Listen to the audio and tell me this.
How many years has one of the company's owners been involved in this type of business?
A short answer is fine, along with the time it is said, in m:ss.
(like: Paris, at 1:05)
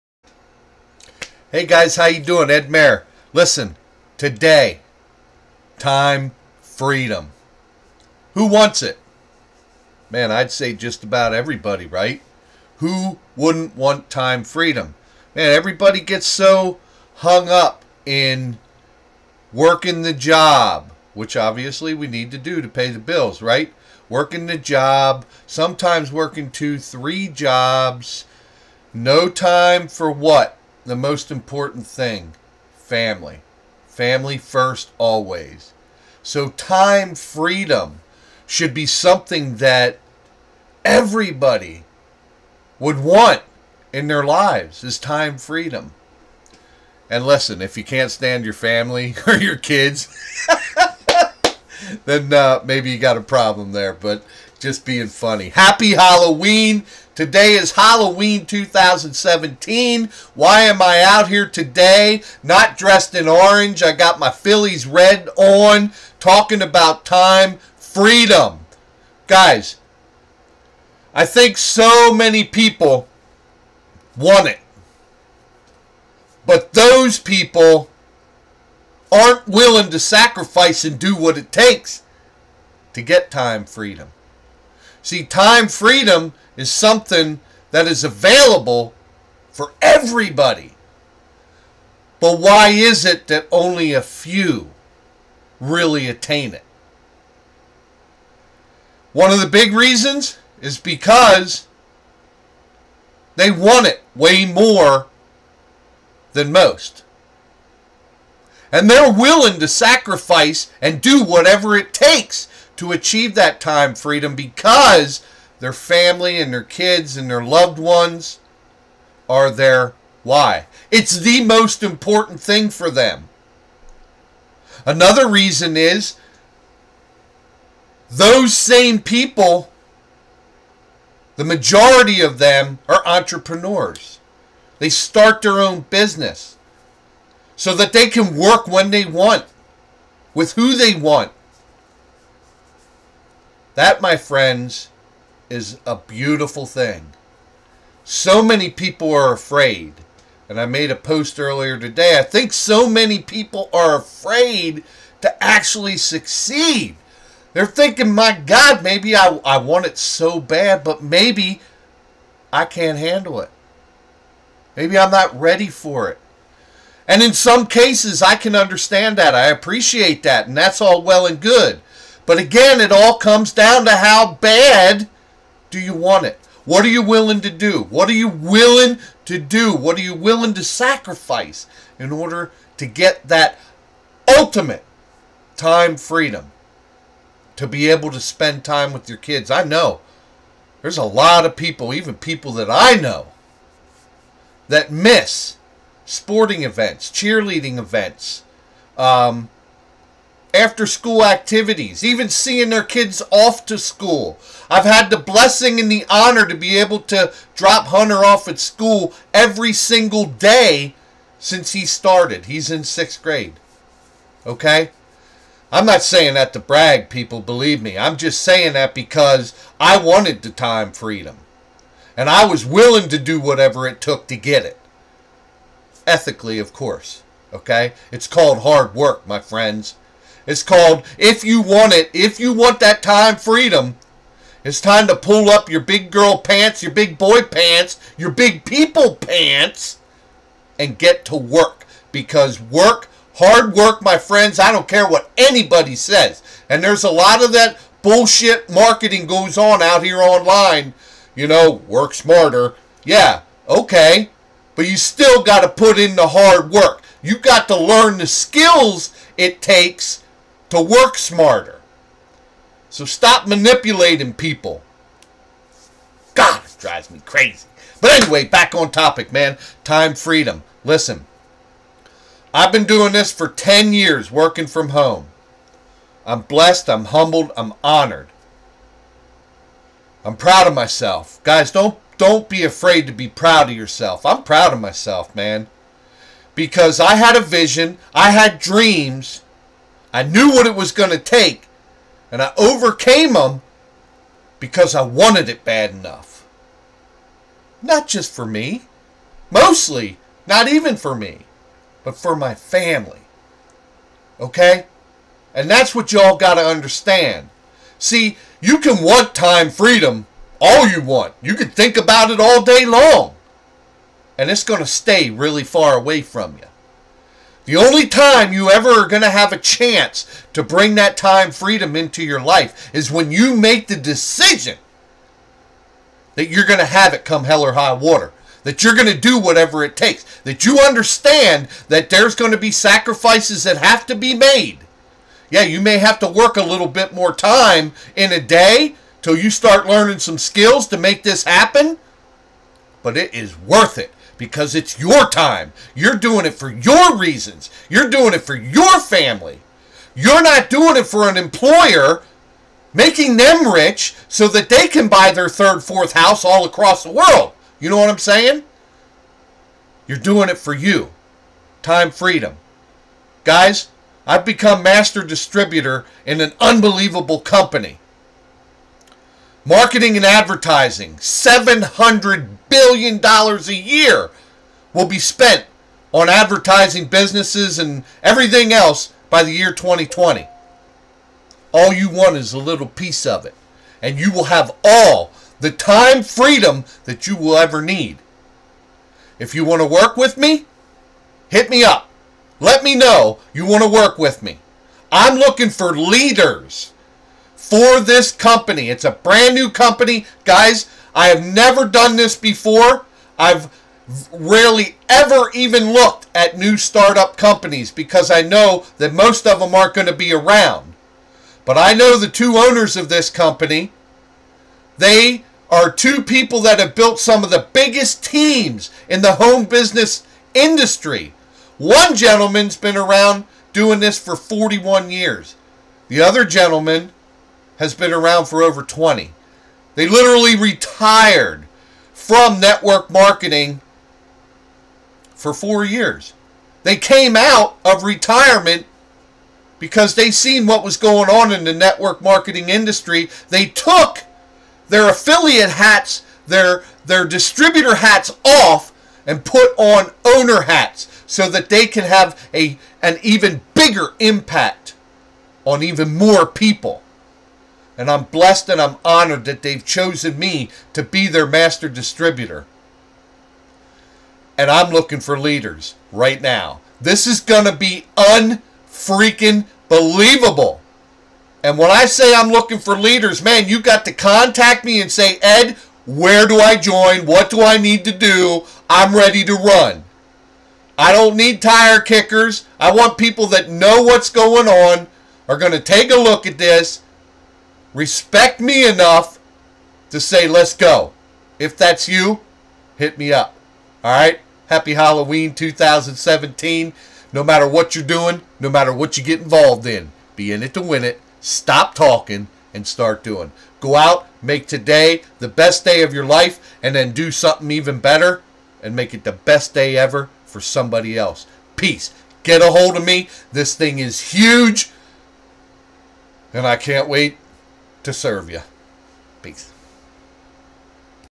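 41 years, at 7:04.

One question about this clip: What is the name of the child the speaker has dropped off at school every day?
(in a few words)
Hunter.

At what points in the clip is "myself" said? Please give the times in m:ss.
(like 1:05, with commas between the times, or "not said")
4:40, 4:44.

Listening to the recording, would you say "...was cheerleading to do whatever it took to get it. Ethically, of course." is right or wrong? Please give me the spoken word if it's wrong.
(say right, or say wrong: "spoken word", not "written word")
wrong: "willing", not "cheerleading".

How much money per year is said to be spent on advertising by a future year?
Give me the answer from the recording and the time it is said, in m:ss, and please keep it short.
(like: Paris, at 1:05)
$700 billion, at 6:11.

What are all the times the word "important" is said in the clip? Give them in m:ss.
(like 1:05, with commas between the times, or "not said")
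0:31, 2:01.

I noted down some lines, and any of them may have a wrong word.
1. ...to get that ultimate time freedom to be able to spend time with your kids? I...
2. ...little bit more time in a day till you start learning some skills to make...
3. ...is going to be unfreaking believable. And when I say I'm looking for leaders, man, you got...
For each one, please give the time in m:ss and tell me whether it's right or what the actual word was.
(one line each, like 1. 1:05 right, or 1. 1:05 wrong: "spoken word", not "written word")
1. 3:02 right
2. 5:36 right
3. 7:47 right.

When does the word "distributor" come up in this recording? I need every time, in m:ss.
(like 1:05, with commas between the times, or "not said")
6:05, 7:27, 7:41.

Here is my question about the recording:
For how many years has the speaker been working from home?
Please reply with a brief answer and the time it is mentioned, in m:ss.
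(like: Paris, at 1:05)
10 years, at 4:33.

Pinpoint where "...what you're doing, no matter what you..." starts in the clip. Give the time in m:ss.
8:17.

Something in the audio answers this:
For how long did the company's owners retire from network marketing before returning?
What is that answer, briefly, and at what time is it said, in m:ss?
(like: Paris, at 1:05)
4 years, at 7:15.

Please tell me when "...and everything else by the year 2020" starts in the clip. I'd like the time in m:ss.
6:17.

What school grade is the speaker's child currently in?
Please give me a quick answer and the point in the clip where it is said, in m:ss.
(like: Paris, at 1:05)
Sixth grade, at 3:32.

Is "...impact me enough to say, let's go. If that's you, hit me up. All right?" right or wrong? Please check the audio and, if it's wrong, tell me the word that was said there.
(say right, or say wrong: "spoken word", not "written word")
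wrong: "respect", not "impact".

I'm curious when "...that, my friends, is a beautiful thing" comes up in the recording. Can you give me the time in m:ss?
2:23.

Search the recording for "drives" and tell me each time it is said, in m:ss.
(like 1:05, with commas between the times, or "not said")
4:26.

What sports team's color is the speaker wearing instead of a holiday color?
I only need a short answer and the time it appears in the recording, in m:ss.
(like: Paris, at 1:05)
Phillies, at 1:04.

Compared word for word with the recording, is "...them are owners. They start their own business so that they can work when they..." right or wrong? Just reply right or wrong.
wrong.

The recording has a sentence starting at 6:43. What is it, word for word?
I've rarely ever even looked at new startup companies because I know that most of them aren't going to be around.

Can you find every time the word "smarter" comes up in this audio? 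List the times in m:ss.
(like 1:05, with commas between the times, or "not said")
4:12, 4:21.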